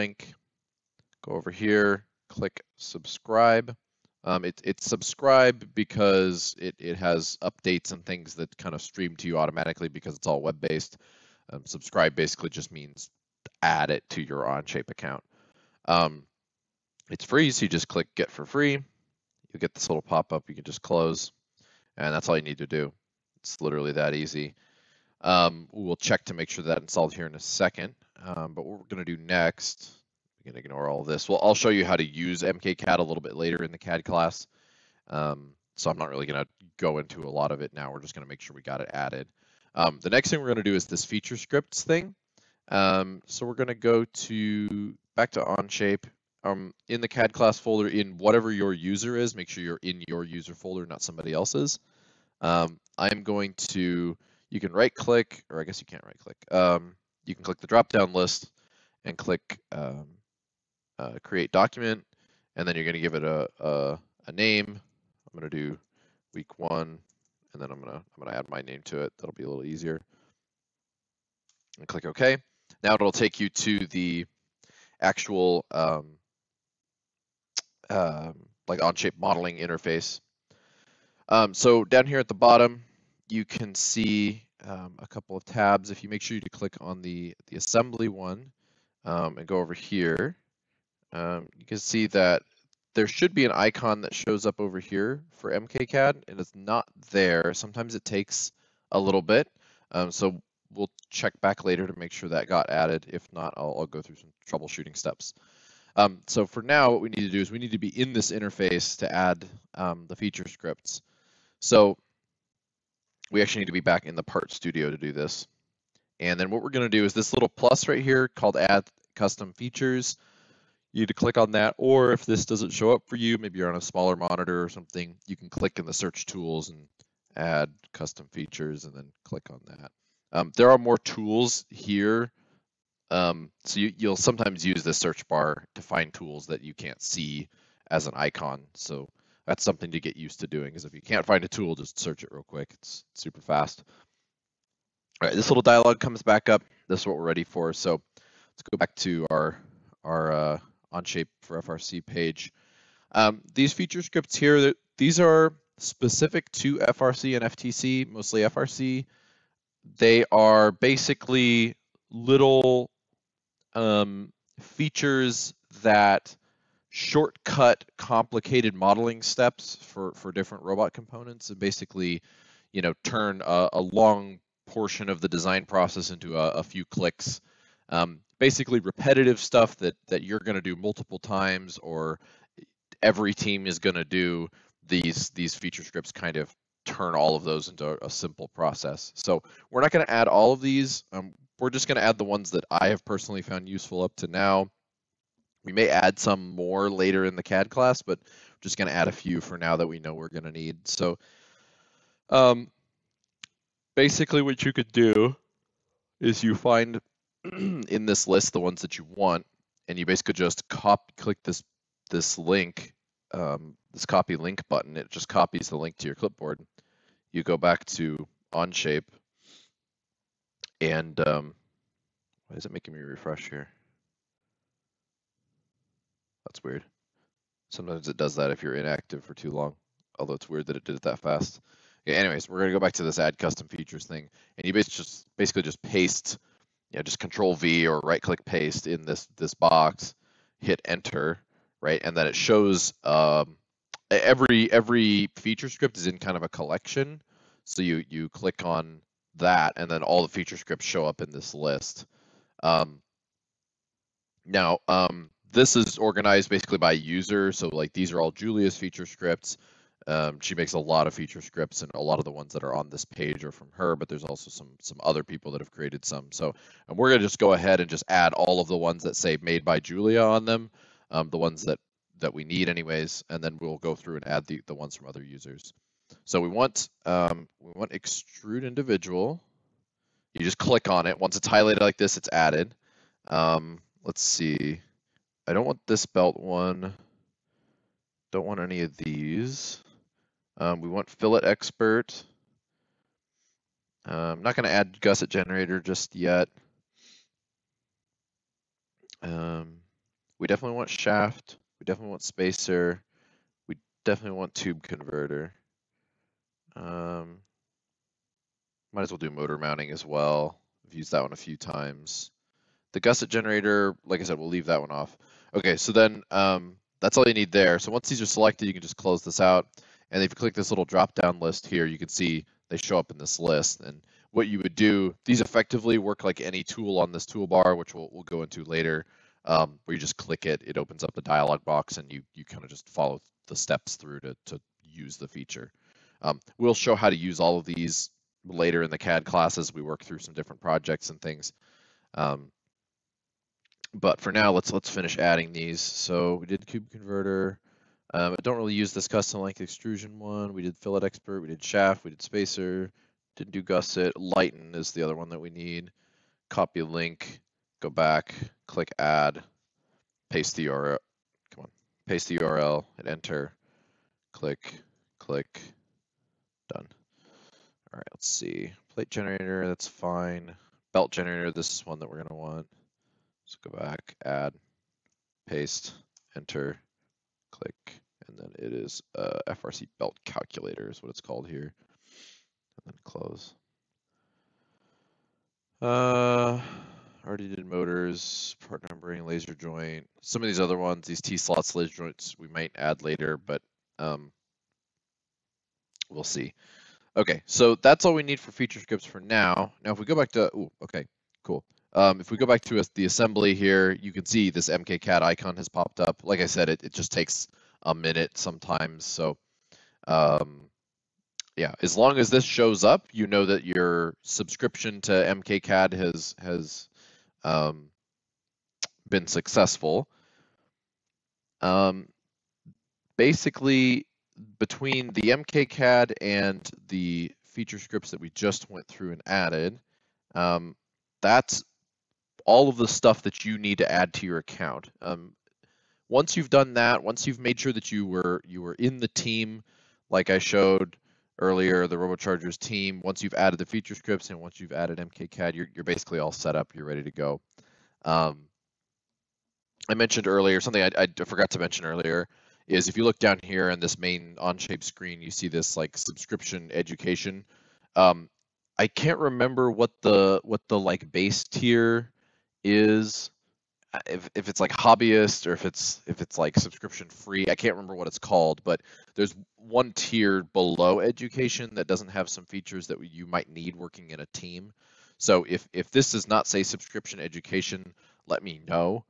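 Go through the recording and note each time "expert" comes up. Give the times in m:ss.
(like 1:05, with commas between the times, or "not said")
4:51, 5:51.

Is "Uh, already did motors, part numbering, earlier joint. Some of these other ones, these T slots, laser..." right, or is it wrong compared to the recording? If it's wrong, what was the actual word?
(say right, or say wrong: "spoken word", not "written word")
wrong: "laser", not "earlier".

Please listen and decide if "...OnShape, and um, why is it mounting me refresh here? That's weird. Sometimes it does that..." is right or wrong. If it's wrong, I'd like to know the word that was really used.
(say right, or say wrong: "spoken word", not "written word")
wrong: "making", not "mounting".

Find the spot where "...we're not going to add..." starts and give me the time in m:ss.
3:09.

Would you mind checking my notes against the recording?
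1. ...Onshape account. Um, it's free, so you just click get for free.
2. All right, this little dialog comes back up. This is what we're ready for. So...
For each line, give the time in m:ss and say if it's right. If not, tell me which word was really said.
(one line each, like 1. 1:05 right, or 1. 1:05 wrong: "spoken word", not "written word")
1. 0:14 right
2. 2:25 right.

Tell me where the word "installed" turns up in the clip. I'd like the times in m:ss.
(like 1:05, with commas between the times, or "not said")
0:26.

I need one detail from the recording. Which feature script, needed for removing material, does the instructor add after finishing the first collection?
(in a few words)
Lighten.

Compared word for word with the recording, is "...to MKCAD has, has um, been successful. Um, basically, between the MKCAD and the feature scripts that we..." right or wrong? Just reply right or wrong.
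right.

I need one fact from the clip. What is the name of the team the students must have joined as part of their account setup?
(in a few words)
RoboChargers.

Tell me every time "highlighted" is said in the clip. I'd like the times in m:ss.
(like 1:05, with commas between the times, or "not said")
4:41.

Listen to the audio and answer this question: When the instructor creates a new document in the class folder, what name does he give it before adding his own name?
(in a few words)
Week one.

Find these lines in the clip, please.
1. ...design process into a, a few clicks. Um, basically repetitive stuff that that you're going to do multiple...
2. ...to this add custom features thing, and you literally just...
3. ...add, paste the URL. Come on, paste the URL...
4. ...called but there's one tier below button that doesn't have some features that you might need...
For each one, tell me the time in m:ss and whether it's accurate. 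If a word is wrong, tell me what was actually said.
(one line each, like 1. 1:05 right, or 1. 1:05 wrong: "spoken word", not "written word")
1. 2:55 right
2. 3:52 wrong: "basically", not "literally"
3. 5:58 right
4. 7:48 wrong: "education", not "button".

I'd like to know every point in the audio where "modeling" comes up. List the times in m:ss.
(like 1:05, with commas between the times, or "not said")
1:19, 2:48.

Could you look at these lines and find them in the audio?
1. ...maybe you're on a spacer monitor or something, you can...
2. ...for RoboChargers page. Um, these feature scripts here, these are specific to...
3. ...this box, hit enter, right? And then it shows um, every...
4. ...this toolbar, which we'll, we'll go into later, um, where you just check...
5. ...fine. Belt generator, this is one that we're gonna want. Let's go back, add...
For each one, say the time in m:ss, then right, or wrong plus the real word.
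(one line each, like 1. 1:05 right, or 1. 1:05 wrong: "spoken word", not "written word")
1. 2:03 wrong: "smaller", not "spacer"
2. 2:31 wrong: "FRC", not "RoboChargers"
3. 3:59 right
4. 5:27 wrong: "click", not "check"
5. 6:09 right.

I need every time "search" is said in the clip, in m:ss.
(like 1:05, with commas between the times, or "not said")
2:05, 2:14, 2:21.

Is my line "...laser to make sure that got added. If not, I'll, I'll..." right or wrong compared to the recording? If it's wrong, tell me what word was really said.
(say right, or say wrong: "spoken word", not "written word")
wrong: "later", not "laser".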